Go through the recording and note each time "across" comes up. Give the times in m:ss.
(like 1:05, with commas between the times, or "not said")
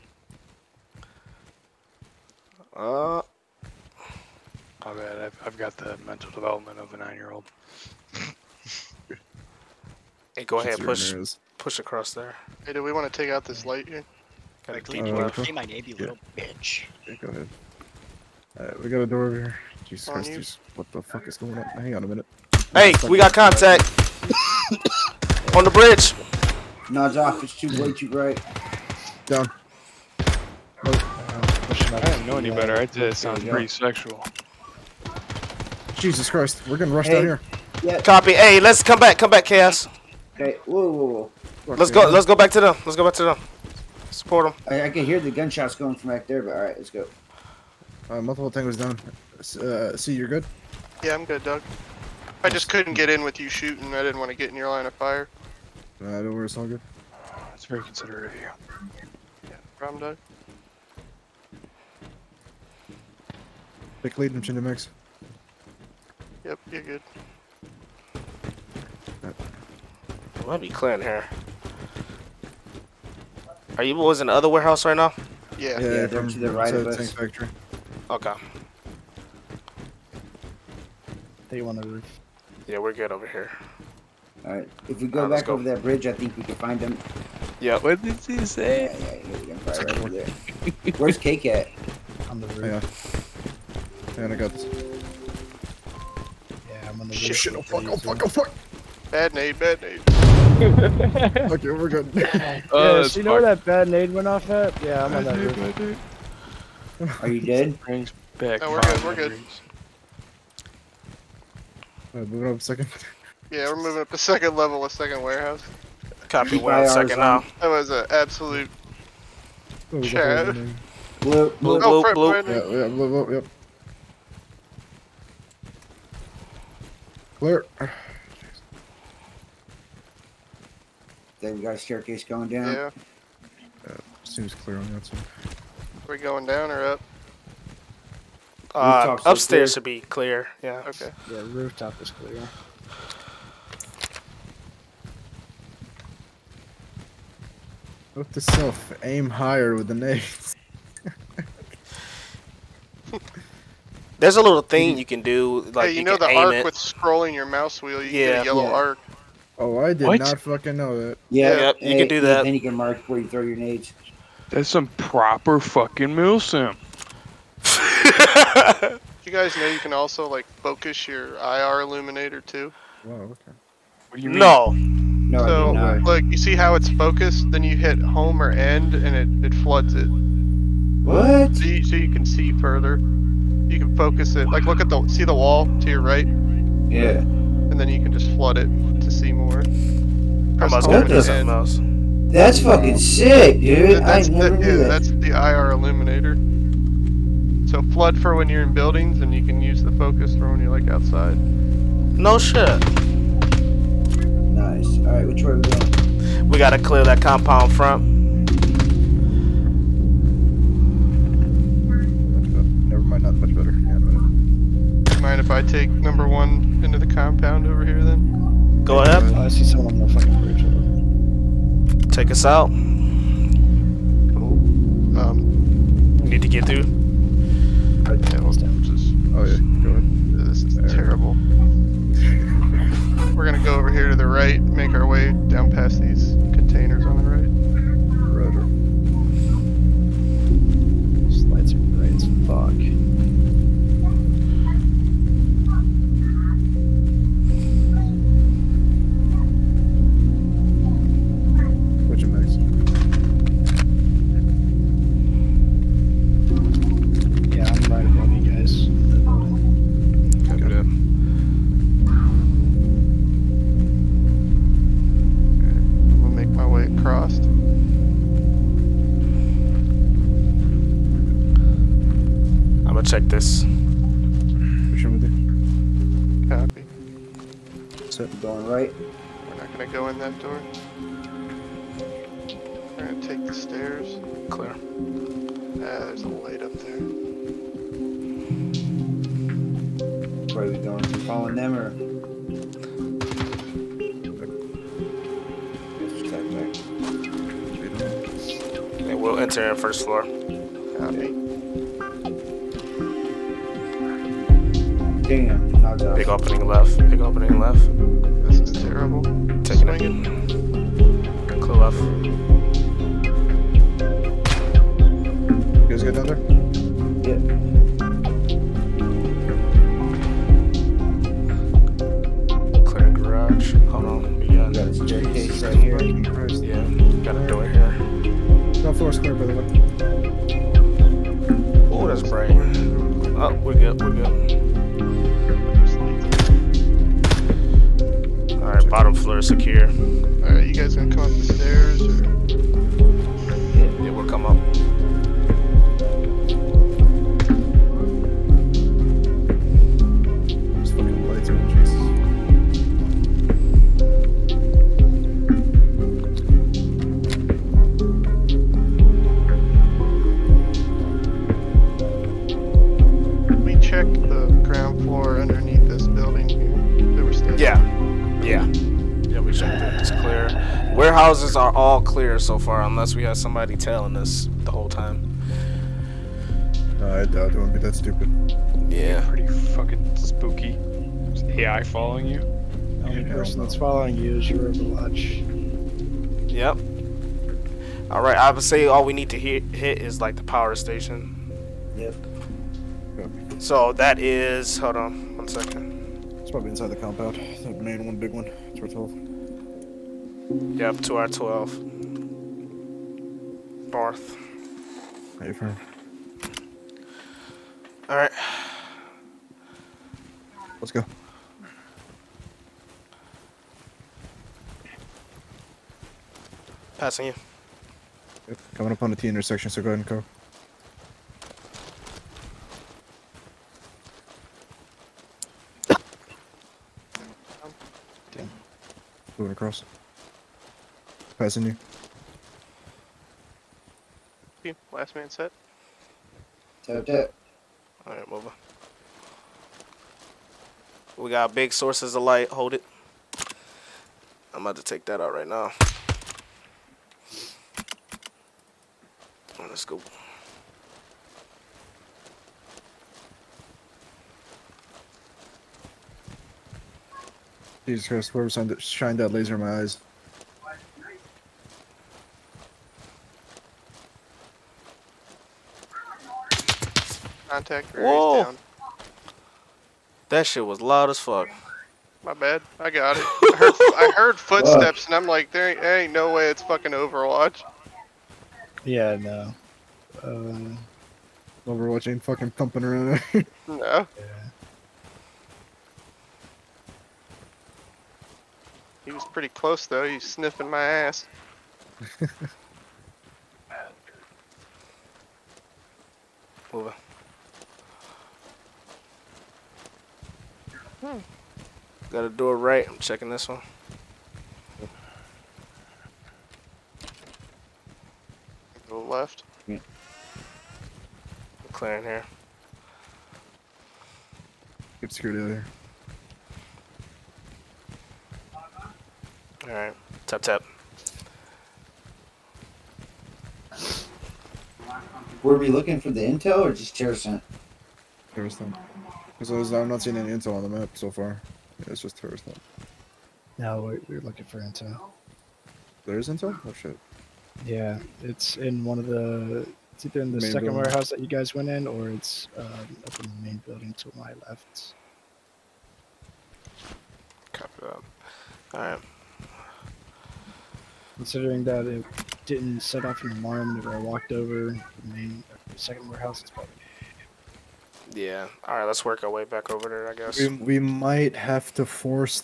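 0:11, 7:09.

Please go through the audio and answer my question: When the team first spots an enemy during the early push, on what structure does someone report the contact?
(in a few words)
The bridge.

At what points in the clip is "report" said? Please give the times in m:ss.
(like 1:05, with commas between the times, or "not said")
not said.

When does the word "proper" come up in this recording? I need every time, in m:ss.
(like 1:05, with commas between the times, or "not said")
2:44.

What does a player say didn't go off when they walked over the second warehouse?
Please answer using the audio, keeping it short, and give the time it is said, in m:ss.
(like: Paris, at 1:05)
An alarm, at 9:12.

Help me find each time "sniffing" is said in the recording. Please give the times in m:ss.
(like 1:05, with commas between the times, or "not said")
8:10.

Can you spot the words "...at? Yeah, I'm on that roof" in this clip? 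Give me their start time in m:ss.
1:44.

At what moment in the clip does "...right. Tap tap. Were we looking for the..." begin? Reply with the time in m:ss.
8:39.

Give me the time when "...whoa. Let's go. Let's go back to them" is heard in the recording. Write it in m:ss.
0:41.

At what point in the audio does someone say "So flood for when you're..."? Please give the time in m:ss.
3:17.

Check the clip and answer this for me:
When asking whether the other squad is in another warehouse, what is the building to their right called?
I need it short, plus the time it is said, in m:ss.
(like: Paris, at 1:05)
Tank factory, at 1:16.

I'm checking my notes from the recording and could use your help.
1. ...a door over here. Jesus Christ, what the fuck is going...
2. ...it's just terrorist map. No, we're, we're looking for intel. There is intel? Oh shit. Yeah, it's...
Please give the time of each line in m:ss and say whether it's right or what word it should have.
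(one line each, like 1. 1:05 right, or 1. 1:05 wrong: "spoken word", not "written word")
1. 0:18 right
2. 8:51 right.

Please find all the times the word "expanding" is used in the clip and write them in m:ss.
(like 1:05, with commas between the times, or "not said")
not said.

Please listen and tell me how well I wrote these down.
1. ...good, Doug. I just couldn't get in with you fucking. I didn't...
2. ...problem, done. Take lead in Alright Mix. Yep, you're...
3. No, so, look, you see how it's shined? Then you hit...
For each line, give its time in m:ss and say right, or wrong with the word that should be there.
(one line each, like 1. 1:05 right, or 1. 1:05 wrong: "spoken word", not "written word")
1. 0:51 wrong: "shooting", not "fucking"
2. 0:59 wrong: "Chinda", not "Alright"
3. 2:55 wrong: "focused", not "shined".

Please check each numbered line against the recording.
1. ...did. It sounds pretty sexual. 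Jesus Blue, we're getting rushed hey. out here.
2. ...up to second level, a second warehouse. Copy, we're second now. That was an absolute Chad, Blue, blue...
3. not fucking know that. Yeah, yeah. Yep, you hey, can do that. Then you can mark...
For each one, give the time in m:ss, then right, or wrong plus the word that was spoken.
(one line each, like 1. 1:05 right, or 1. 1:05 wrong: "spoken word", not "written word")
1. 0:32 wrong: "Christ", not "Blue"
2. 1:54 right
3. 2:40 right.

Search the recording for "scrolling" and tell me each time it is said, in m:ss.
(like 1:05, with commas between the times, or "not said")
2:36.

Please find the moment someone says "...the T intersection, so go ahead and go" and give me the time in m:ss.
6:59.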